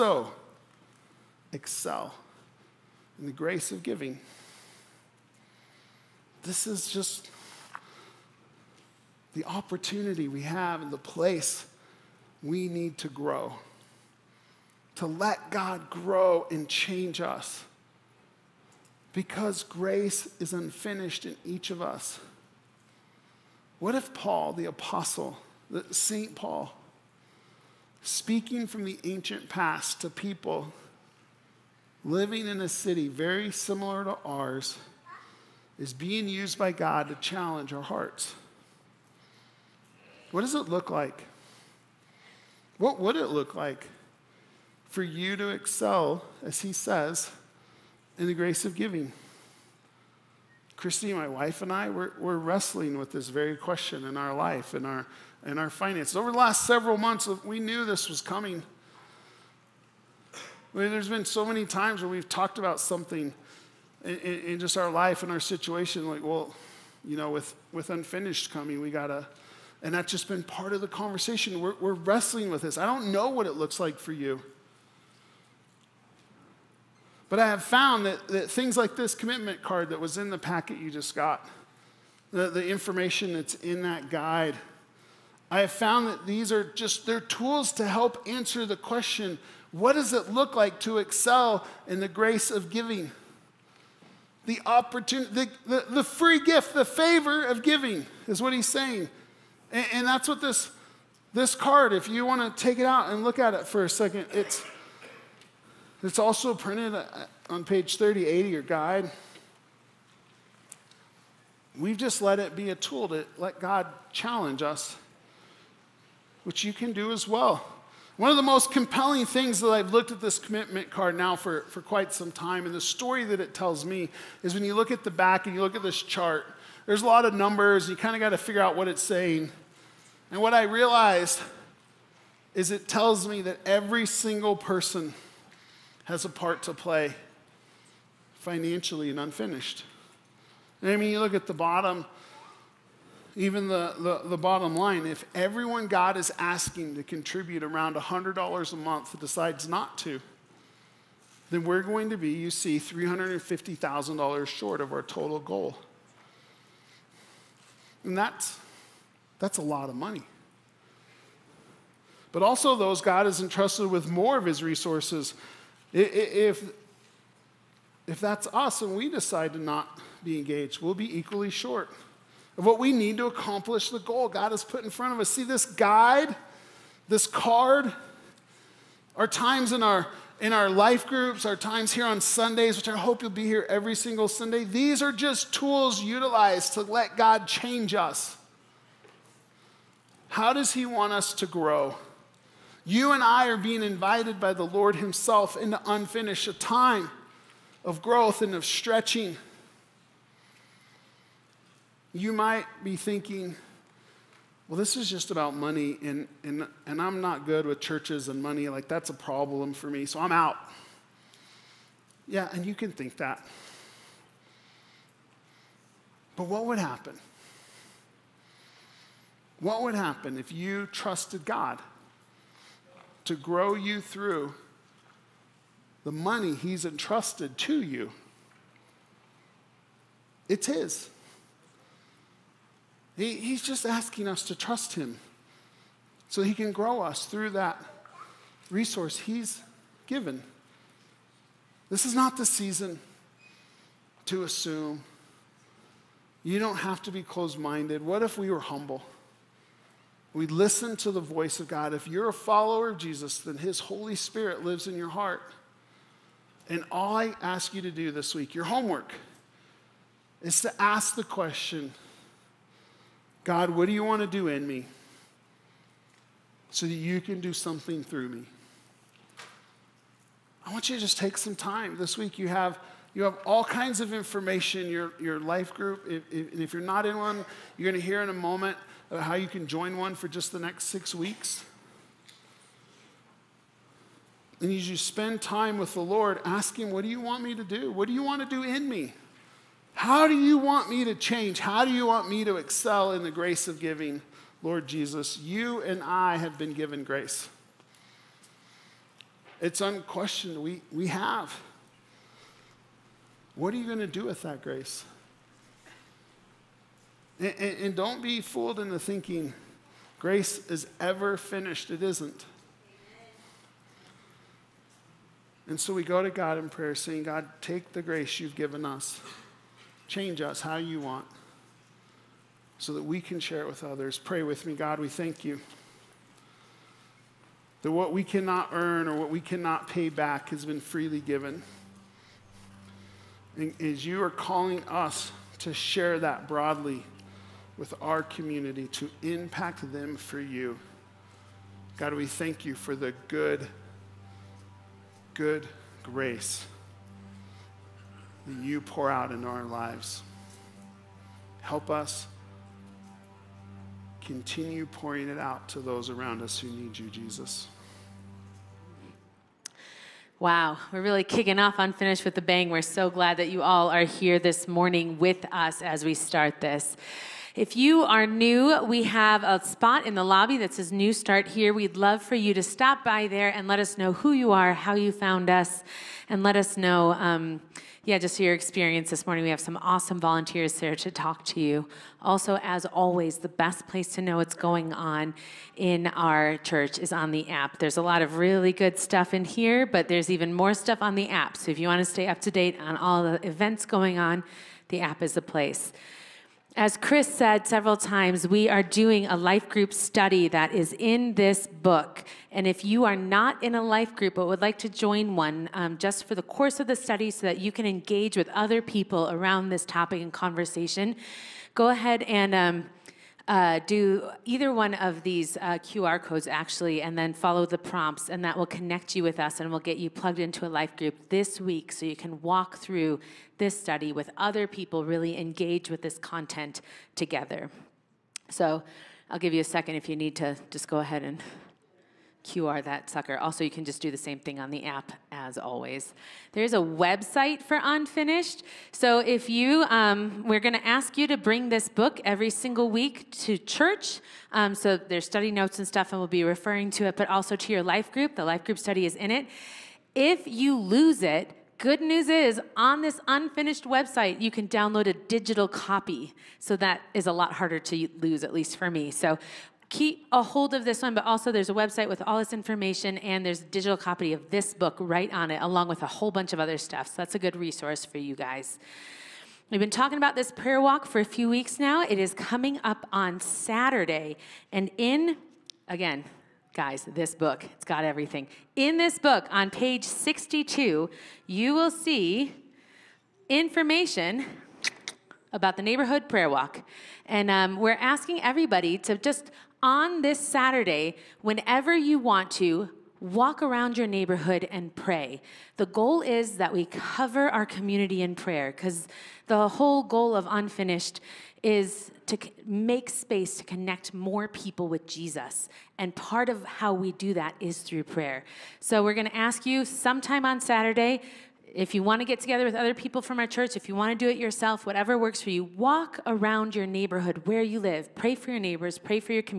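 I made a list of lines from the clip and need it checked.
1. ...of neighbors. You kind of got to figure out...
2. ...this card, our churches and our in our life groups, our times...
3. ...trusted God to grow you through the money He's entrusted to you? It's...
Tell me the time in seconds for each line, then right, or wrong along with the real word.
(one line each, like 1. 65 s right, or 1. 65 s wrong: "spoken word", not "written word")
1. 127 s wrong: "numbers", not "neighbors"
2. 177 s wrong: "times", not "churches"
3. 220 s right.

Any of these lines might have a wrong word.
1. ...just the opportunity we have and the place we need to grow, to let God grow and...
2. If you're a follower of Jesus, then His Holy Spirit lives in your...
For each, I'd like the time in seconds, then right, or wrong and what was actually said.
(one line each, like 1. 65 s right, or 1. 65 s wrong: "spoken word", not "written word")
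1. 6 s right
2. 251 s right.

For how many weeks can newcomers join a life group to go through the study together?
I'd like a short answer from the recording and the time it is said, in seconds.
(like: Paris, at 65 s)
6, at 280 s.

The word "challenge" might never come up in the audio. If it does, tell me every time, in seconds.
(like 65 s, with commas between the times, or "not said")
37 s, 114 s.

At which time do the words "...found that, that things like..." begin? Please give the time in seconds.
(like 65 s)
77 s.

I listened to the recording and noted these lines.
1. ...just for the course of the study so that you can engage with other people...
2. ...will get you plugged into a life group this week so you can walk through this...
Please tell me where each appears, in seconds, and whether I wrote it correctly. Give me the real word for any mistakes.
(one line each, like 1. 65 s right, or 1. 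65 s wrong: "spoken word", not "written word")
1. 405 s right
2. 419 s right.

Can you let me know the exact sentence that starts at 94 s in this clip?
The opportunity, the, the, the free gift, the favor of giving is what he's saying.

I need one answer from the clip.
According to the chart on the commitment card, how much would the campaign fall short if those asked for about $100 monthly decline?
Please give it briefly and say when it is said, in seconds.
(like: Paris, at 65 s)
$350,000, at 152 s.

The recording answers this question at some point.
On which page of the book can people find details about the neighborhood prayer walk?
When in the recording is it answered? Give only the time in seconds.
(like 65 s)
479 s.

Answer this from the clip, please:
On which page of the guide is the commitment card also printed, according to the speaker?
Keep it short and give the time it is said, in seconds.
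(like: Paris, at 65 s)
38, at 107 s.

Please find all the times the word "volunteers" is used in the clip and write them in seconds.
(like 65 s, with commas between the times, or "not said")
380 s.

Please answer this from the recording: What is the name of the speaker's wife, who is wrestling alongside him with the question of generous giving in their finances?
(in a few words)
Christy.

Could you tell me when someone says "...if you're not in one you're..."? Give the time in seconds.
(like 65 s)
276 s.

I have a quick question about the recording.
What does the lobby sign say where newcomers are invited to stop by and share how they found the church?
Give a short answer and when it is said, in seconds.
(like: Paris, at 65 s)
New Start here, at 370 s.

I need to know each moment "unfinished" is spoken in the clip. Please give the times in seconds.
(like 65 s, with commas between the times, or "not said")
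20 s, 67 s, 139 s, 195 s, 361 s, 437 s, 453 s, 500 s.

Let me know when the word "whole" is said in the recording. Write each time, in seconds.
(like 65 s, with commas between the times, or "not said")
466 s, 499 s.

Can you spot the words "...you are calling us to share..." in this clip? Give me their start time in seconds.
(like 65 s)
334 s.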